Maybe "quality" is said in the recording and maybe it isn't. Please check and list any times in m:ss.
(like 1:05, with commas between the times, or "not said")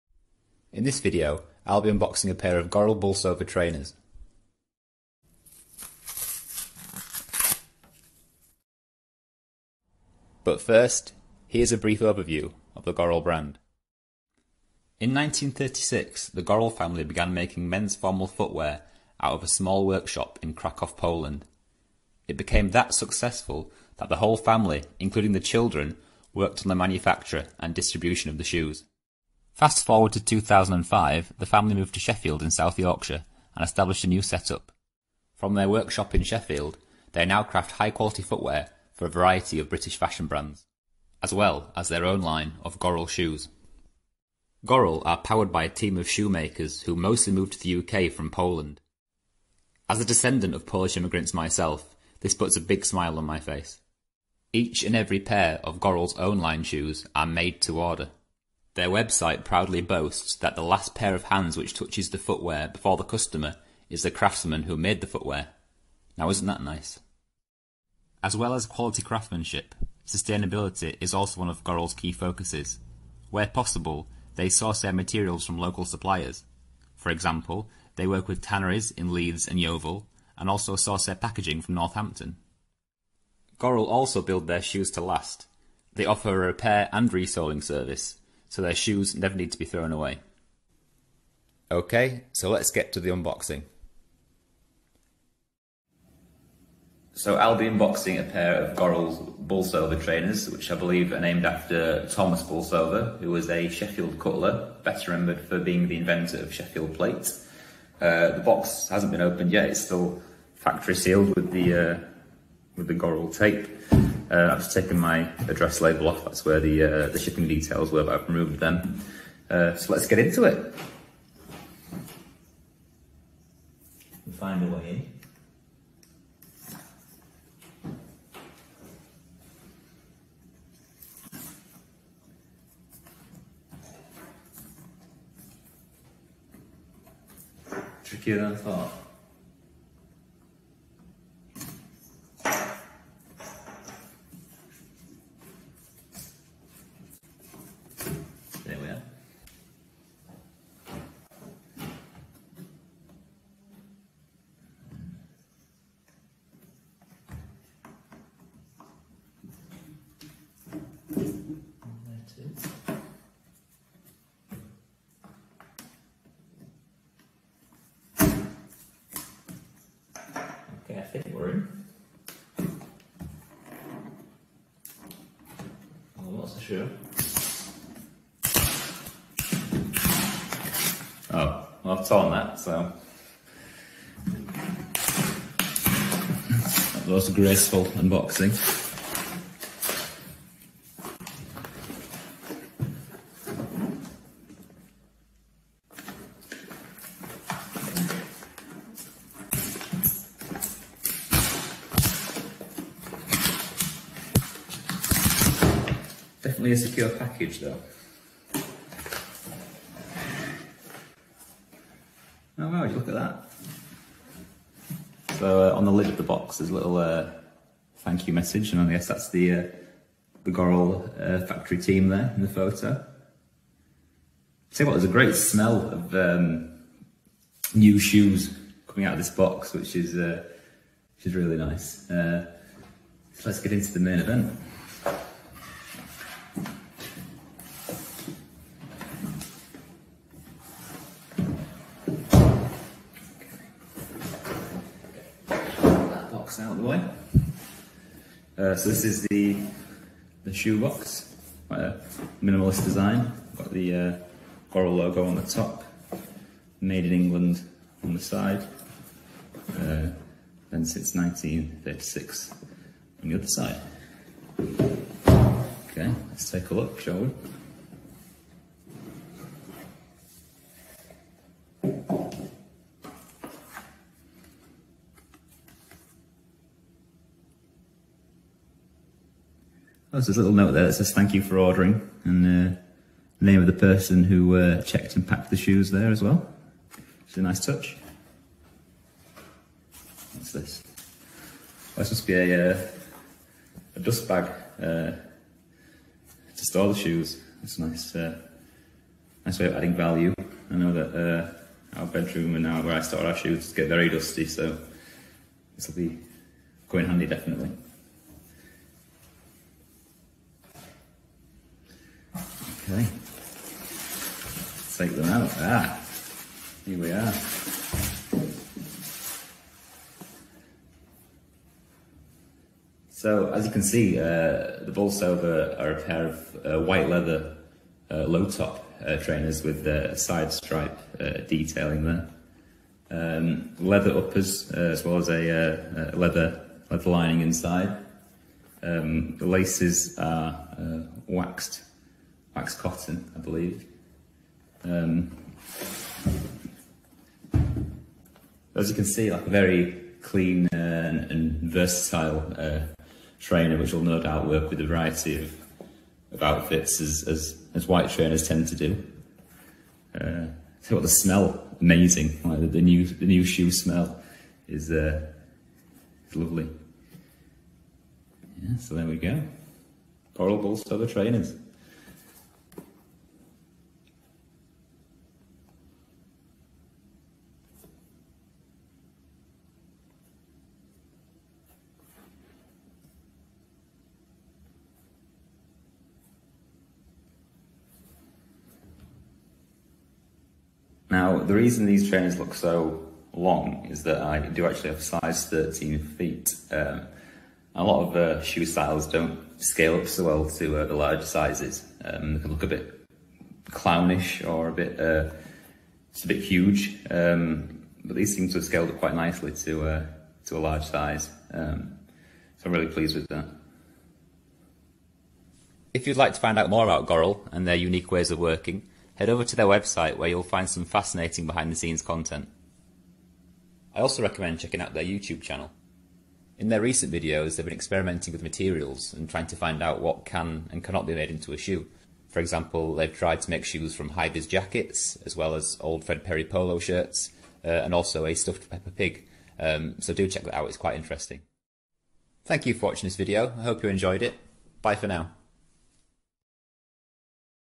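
0:37, 1:08.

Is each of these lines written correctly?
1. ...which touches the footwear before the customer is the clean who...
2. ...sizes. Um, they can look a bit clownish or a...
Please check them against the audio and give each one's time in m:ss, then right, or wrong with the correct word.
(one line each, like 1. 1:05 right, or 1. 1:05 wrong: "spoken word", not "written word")
1. 1:01 wrong: "craftsman", not "clean"
2. 6:41 right.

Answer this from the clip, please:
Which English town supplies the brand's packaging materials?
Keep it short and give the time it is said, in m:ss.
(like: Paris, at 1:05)
Northampton, at 1:21.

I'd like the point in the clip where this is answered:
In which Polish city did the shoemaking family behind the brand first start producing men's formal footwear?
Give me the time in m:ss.
0:20.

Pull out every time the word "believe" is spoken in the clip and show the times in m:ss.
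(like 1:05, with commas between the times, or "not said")
1:40, 5:43.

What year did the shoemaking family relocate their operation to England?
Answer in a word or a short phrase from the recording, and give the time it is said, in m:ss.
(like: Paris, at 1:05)
2005, at 0:30.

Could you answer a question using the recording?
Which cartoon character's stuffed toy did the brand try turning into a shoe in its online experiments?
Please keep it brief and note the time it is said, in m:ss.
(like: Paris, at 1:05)
Peppa Pig, at 7:18.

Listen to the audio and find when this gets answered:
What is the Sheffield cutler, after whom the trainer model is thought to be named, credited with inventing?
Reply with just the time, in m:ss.
1:46.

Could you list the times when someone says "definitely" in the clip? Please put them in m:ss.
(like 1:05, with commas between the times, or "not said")
3:26, 5:07.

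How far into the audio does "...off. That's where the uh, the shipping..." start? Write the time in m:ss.
1:56.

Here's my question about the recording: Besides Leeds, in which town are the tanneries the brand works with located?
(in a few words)
Yeovil.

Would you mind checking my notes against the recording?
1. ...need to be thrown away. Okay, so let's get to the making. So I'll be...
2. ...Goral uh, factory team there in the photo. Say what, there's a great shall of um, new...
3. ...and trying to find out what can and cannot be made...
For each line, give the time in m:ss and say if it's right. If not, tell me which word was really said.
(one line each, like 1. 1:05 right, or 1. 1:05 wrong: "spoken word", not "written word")
1. 1:29 wrong: "unboxing", not "making"
2. 3:40 wrong: "smell", not "shall"
3. 7:09 right.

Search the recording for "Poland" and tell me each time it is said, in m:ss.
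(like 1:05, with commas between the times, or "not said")
0:20, 0:48.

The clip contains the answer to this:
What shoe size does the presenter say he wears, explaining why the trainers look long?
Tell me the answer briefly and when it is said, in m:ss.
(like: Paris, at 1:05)
13, at 6:35.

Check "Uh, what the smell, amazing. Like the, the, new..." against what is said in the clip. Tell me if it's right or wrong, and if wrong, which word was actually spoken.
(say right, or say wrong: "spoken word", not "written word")
right.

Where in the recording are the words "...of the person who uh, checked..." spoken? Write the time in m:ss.
4:43.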